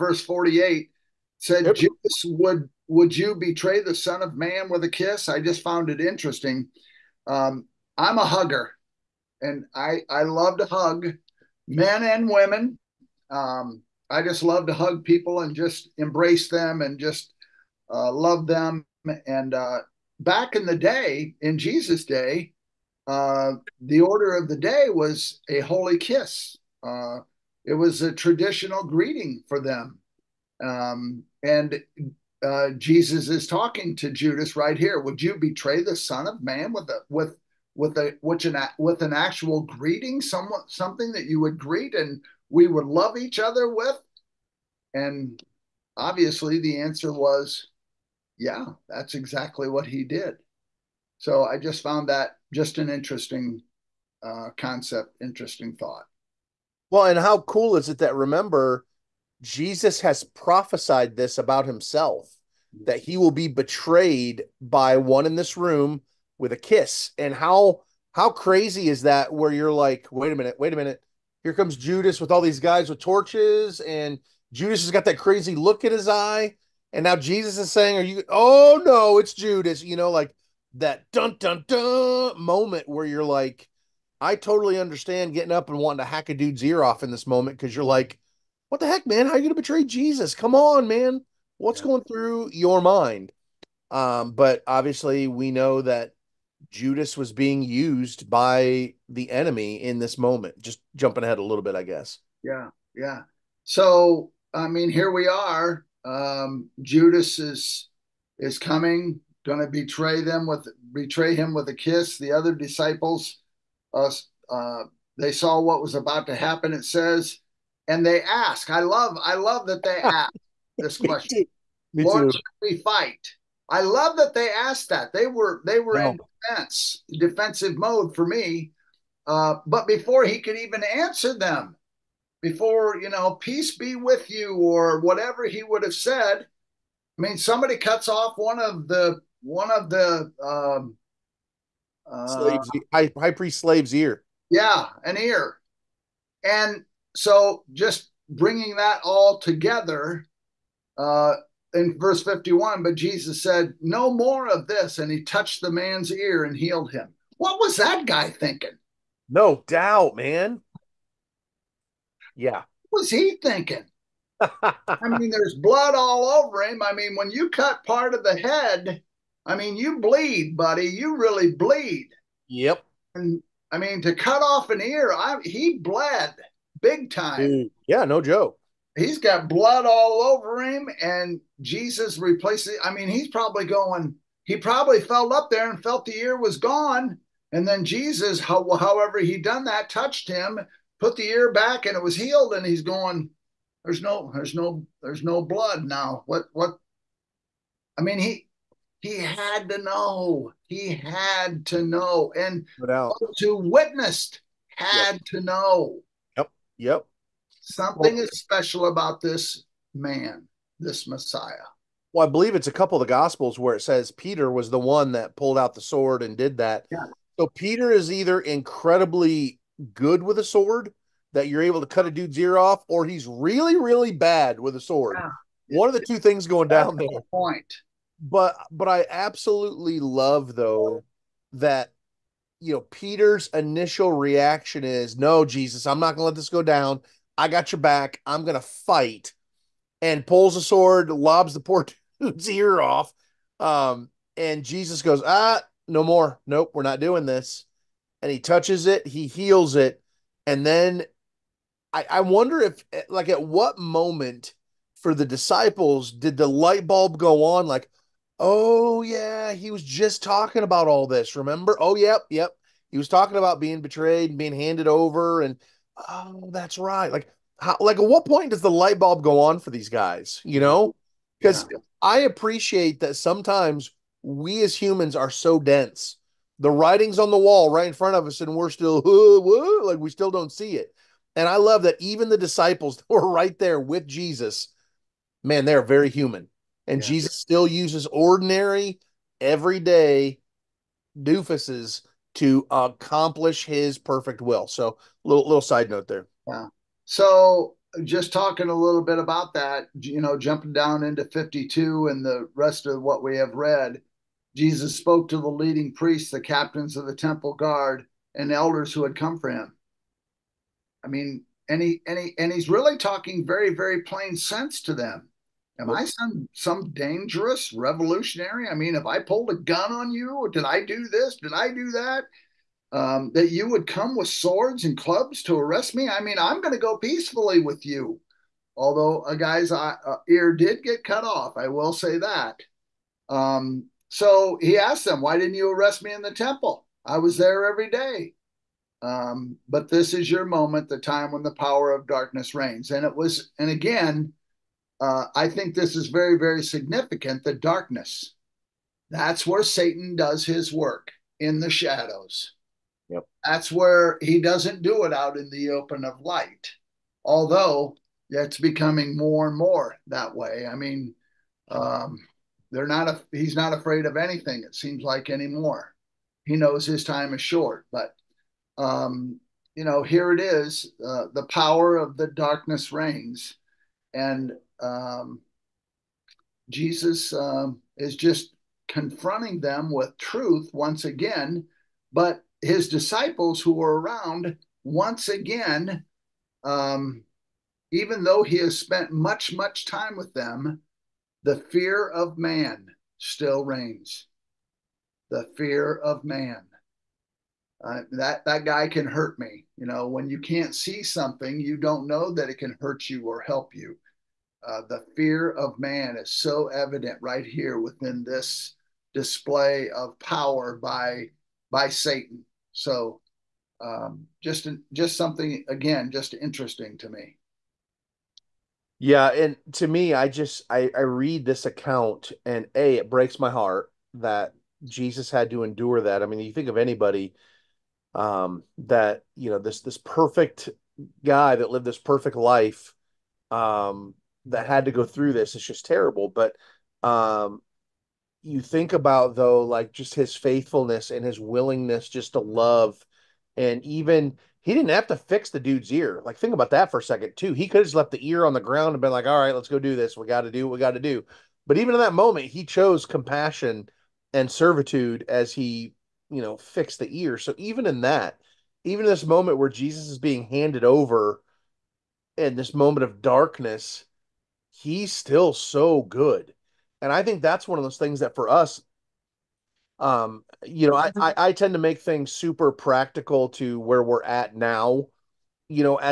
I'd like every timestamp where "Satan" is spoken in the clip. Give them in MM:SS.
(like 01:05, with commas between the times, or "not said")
05:49, 06:51.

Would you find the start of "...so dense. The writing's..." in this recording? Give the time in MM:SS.
04:35.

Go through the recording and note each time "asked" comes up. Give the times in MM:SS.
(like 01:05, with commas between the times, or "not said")
02:04, 05:34.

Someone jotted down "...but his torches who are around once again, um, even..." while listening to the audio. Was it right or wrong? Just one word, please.
wrong.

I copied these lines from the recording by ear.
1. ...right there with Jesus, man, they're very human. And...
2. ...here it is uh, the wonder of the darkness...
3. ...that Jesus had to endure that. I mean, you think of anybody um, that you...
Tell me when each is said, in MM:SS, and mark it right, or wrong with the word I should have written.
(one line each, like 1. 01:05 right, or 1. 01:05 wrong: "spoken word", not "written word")
1. 04:43 right
2. 06:10 wrong: "power", not "wonder"
3. 07:04 right.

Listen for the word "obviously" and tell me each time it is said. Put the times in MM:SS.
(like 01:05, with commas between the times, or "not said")
00:45, 01:34.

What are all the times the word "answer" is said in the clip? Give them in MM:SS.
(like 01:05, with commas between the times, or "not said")
00:46, 02:10.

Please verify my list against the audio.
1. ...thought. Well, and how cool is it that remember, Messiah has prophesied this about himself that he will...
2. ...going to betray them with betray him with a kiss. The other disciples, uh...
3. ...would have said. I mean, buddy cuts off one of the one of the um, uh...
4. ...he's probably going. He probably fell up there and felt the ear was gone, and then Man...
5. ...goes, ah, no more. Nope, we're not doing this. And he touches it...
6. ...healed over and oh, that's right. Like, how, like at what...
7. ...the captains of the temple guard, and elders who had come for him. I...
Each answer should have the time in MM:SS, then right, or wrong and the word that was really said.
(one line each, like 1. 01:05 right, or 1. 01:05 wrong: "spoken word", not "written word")
1. 00:55 wrong: "Jesus", not "Messiah"
2. 01:49 right
3. 02:15 wrong: "somebody", not "buddy"
4. 03:03 wrong: "Jesus", not "Man"
5. 04:05 right
6. 04:24 wrong: "handed", not "healed"
7. 05:06 right.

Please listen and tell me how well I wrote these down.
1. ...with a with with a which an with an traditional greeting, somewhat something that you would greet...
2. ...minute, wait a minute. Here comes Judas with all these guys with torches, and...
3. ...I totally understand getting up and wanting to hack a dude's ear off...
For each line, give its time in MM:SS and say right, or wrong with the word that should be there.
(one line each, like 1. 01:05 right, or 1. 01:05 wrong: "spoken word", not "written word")
1. 00:36 wrong: "actual", not "traditional"
2. 01:10 right
3. 01:24 right.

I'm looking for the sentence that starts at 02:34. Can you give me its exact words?
And he touched the man's ear and healed him.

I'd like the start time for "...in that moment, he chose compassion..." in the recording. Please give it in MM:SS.
07:31.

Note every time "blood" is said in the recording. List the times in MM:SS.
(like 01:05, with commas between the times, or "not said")
02:45, 02:59, 03:15.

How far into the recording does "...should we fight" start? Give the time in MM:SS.
02:02.